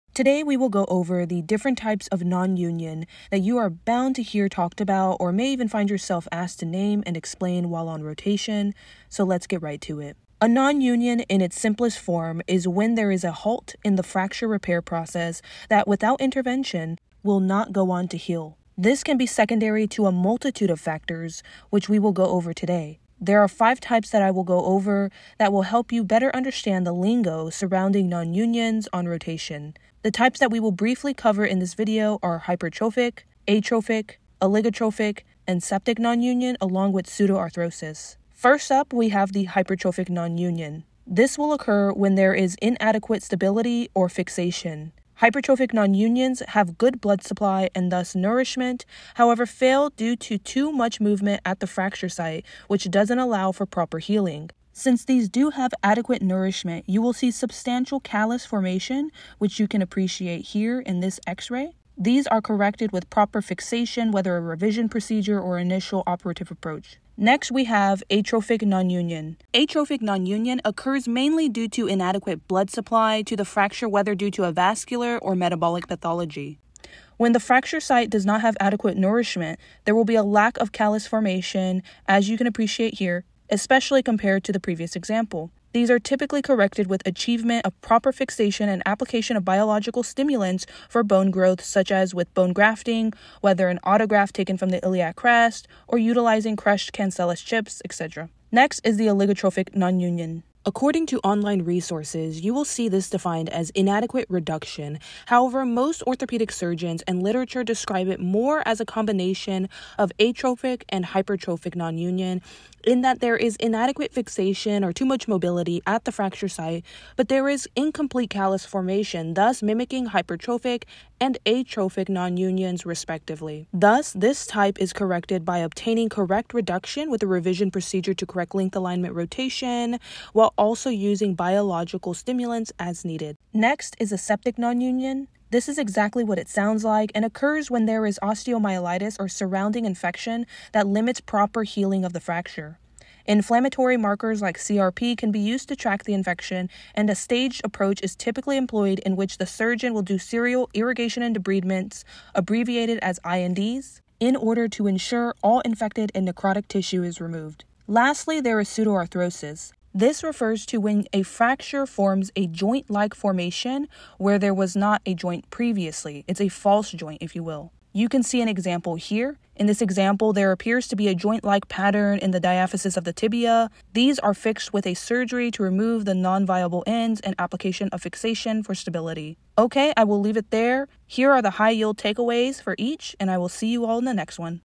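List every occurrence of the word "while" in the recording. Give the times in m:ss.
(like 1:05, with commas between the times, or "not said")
0:07, 2:10.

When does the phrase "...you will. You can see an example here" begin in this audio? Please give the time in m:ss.
2:47.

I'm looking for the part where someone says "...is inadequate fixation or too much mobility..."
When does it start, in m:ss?
1:53.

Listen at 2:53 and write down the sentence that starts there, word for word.
These are fixed with a surgery to remove the non-viable ends and application of fixation for stability.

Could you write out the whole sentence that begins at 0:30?
The types that we will briefly cover in this video are hypertrophic, atrophic, oligotrophic, and septic non union, along with pseudoarthrosis.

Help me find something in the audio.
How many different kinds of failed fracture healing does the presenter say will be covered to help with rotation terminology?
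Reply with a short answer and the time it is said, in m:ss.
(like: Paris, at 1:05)
5, at 0:23.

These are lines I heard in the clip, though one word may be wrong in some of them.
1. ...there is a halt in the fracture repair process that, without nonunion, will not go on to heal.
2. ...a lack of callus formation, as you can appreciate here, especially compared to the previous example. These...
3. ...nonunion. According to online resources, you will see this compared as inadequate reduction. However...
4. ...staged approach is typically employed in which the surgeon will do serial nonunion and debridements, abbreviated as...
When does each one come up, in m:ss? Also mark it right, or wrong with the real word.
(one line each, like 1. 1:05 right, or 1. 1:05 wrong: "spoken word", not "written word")
1. 0:12 wrong: "intervention", not "nonunion"
2. 1:20 right
3. 1:39 wrong: "defined", not "compared"
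4. 2:27 wrong: "irrigation", not "nonunion".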